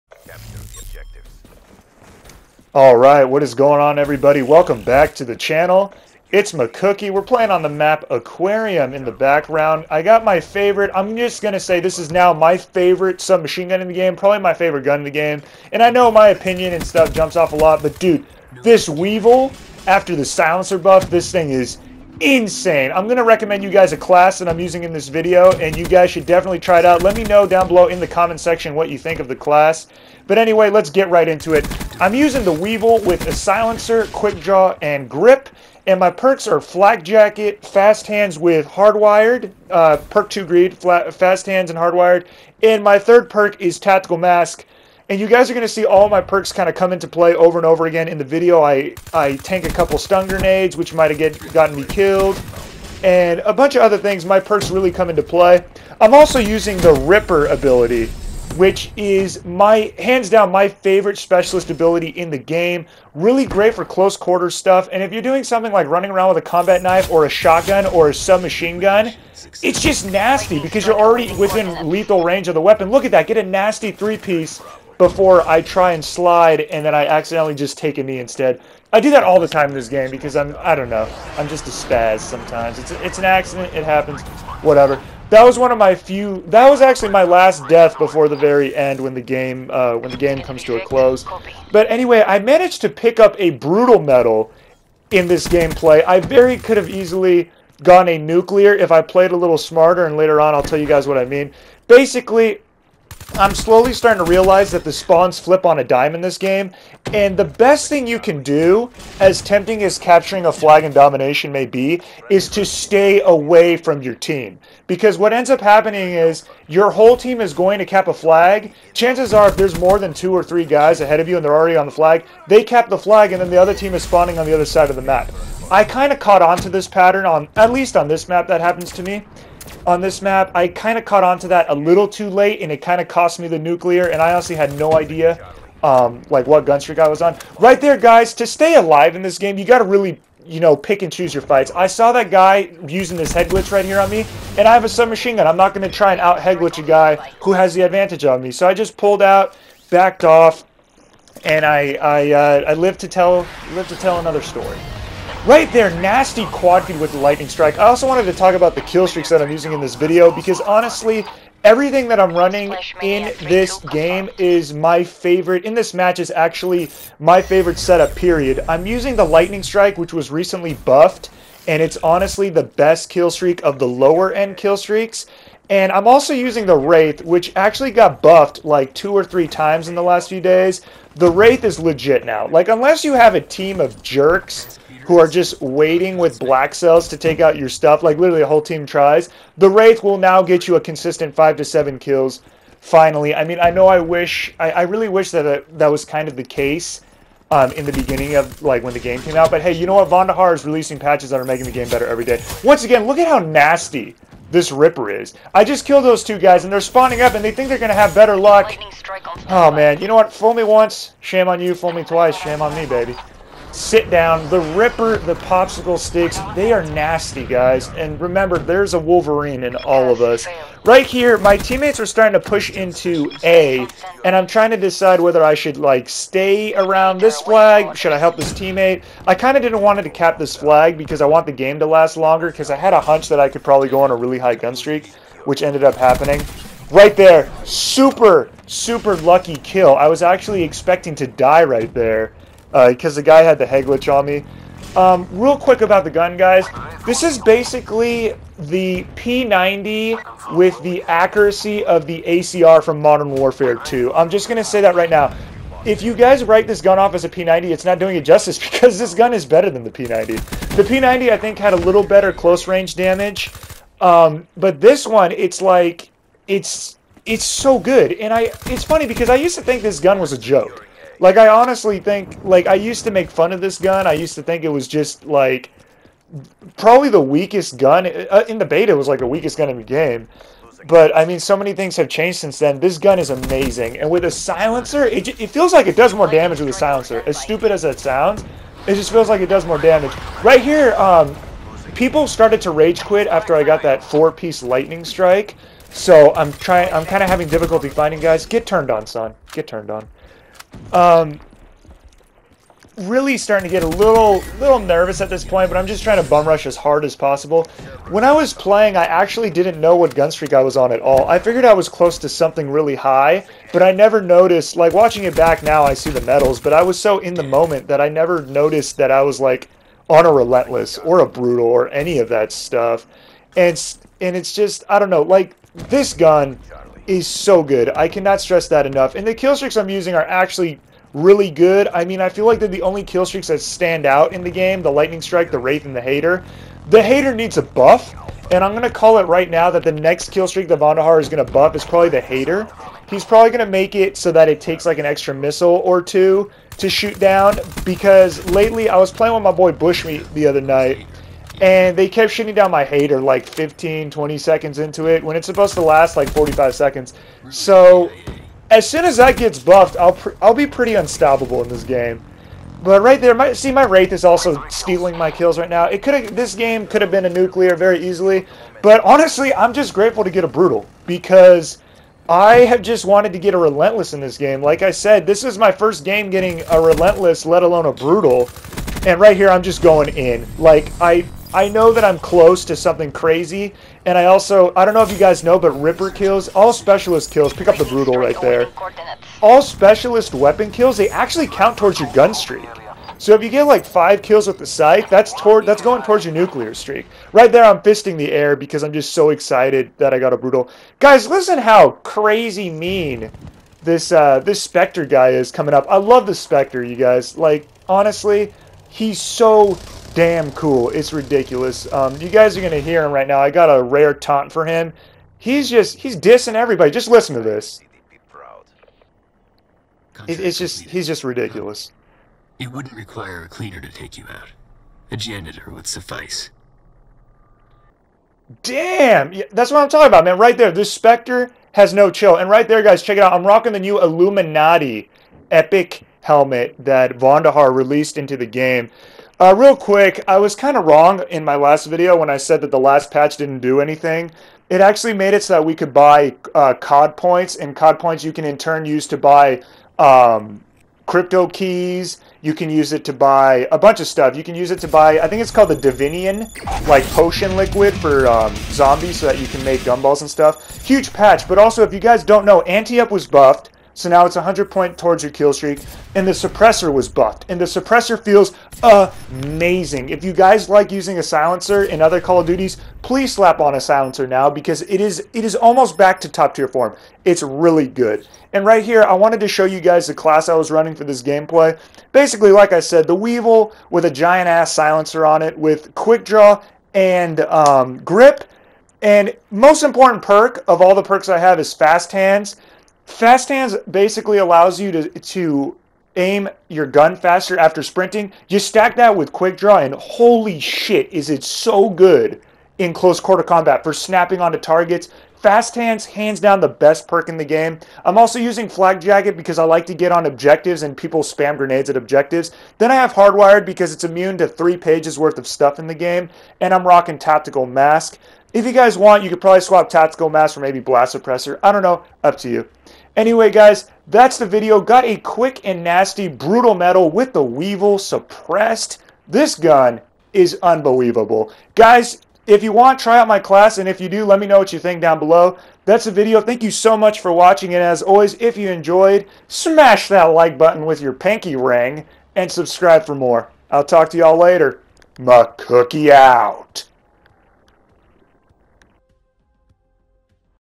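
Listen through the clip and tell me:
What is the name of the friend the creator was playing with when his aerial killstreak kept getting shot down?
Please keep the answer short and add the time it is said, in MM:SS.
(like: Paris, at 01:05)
Bushmeat, at 05:49.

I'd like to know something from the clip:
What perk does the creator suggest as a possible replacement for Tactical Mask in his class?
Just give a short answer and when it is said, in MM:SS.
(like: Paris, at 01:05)
Blast Suppressor, at 08:40.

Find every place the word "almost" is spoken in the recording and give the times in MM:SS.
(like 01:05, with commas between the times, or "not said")
07:55.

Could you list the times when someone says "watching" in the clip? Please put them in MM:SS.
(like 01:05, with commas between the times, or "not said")
05:14, 08:57.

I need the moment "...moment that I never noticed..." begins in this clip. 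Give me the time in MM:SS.
05:17.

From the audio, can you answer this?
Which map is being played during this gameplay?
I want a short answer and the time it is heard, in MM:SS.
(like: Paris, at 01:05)
Aquarium, at 00:08.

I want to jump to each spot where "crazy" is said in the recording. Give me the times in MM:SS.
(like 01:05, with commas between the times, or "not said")
06:23, 06:42.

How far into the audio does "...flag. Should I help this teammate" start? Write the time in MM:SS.
03:47.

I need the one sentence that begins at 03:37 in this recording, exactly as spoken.
And remember, there's a Wolverine in all of us.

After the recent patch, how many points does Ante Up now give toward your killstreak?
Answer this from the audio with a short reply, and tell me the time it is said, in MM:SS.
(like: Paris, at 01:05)
100, at 07:44.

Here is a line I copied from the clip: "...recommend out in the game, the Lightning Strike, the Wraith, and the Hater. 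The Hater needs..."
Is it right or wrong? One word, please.
wrong.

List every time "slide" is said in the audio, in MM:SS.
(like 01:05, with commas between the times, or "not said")
01:16.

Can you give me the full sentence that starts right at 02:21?
I saw that guy using this head glitch right here on me, and I have a submachine gun.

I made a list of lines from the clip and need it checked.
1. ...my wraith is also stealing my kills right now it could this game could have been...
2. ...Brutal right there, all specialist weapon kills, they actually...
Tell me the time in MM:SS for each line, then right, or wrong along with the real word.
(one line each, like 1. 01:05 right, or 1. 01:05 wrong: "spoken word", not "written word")
1. 06:03 right
2. 06:27 right.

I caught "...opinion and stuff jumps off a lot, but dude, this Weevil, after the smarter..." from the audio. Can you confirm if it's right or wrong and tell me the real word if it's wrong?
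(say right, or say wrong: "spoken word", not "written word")
wrong: "silencer", not "smarter".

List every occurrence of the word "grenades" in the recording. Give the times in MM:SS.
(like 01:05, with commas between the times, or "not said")
00:50, 08:31.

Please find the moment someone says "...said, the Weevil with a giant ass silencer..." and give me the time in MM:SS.
08:02.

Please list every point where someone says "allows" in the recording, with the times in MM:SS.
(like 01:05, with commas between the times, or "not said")
08:14.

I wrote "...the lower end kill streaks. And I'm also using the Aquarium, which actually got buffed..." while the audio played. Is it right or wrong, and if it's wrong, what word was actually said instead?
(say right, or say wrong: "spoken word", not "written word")
wrong: "Wraith", not "Aquarium".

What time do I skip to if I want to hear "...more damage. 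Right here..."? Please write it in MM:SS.
04:49.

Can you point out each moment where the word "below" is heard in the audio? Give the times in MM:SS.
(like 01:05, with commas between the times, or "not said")
00:27, 08:55.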